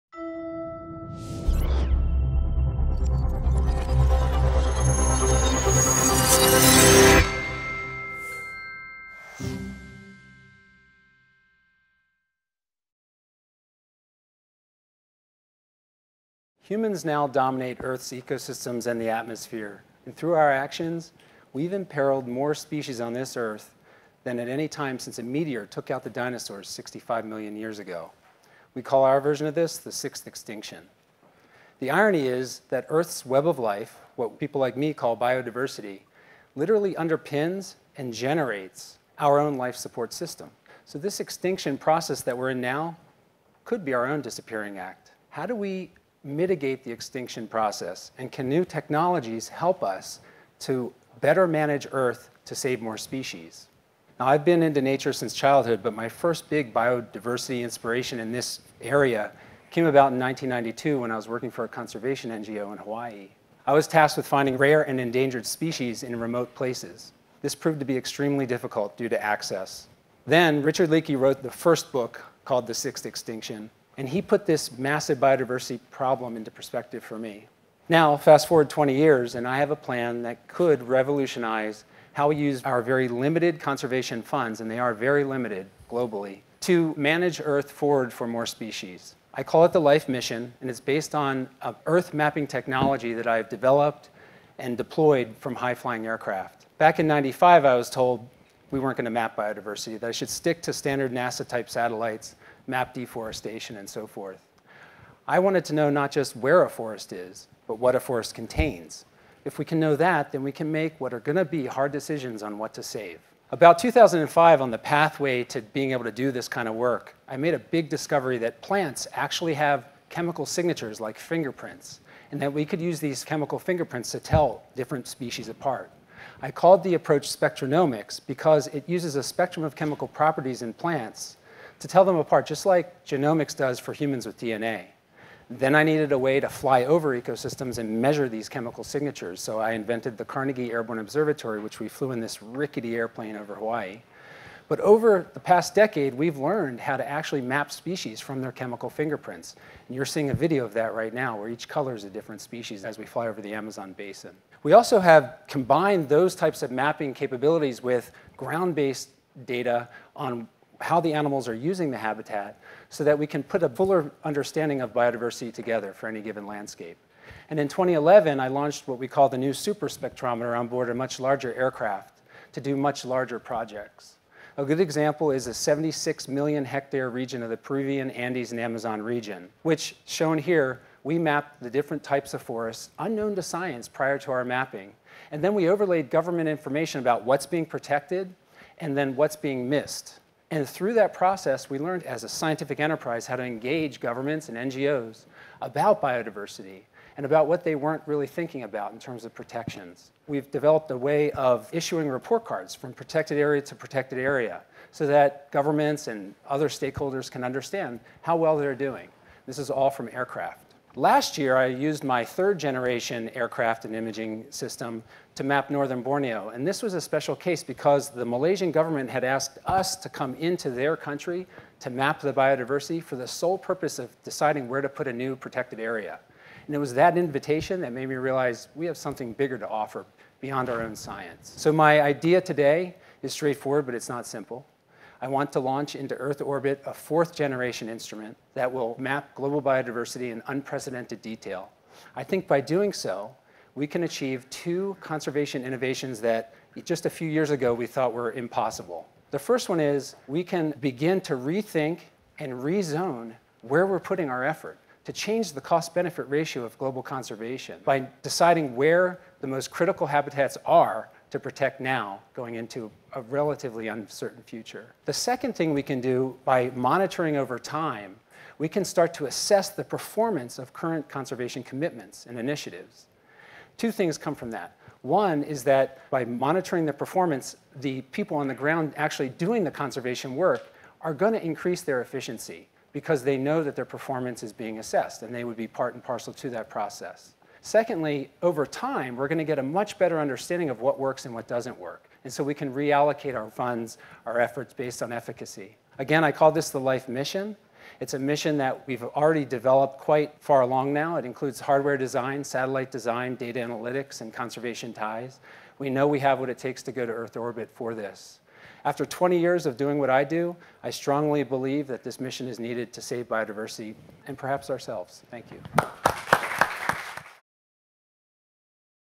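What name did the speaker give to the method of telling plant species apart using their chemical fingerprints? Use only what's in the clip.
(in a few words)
spectronomics.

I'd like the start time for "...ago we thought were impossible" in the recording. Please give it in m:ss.
4:07.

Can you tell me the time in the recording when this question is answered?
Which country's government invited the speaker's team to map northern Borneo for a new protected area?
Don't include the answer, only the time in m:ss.
3:38.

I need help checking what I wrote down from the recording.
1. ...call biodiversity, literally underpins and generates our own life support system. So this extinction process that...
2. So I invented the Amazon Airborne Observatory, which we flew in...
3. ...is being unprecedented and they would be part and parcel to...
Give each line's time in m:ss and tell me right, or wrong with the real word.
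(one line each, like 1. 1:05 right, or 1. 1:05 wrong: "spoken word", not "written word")
1. 0:34 right
2. 2:19 wrong: "Carnegie", not "Amazon"
3. 4:44 wrong: "assessed", not "unprecedented".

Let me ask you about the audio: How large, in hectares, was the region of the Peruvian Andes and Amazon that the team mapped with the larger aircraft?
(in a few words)
76 million hectares.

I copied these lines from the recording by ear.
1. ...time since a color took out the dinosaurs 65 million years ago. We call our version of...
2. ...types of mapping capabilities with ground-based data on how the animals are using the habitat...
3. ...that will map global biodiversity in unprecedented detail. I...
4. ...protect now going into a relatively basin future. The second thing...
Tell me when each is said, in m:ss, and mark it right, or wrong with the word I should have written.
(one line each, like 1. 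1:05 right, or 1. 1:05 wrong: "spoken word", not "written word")
1. 0:24 wrong: "meteor", not "color"
2. 2:36 right
3. 3:58 right
4. 4:21 wrong: "uncertain", not "basin".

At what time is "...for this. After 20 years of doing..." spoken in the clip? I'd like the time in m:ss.
5:07.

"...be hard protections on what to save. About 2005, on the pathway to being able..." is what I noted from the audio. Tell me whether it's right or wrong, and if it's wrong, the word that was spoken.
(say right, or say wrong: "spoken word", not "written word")
wrong: "decisions", not "protections".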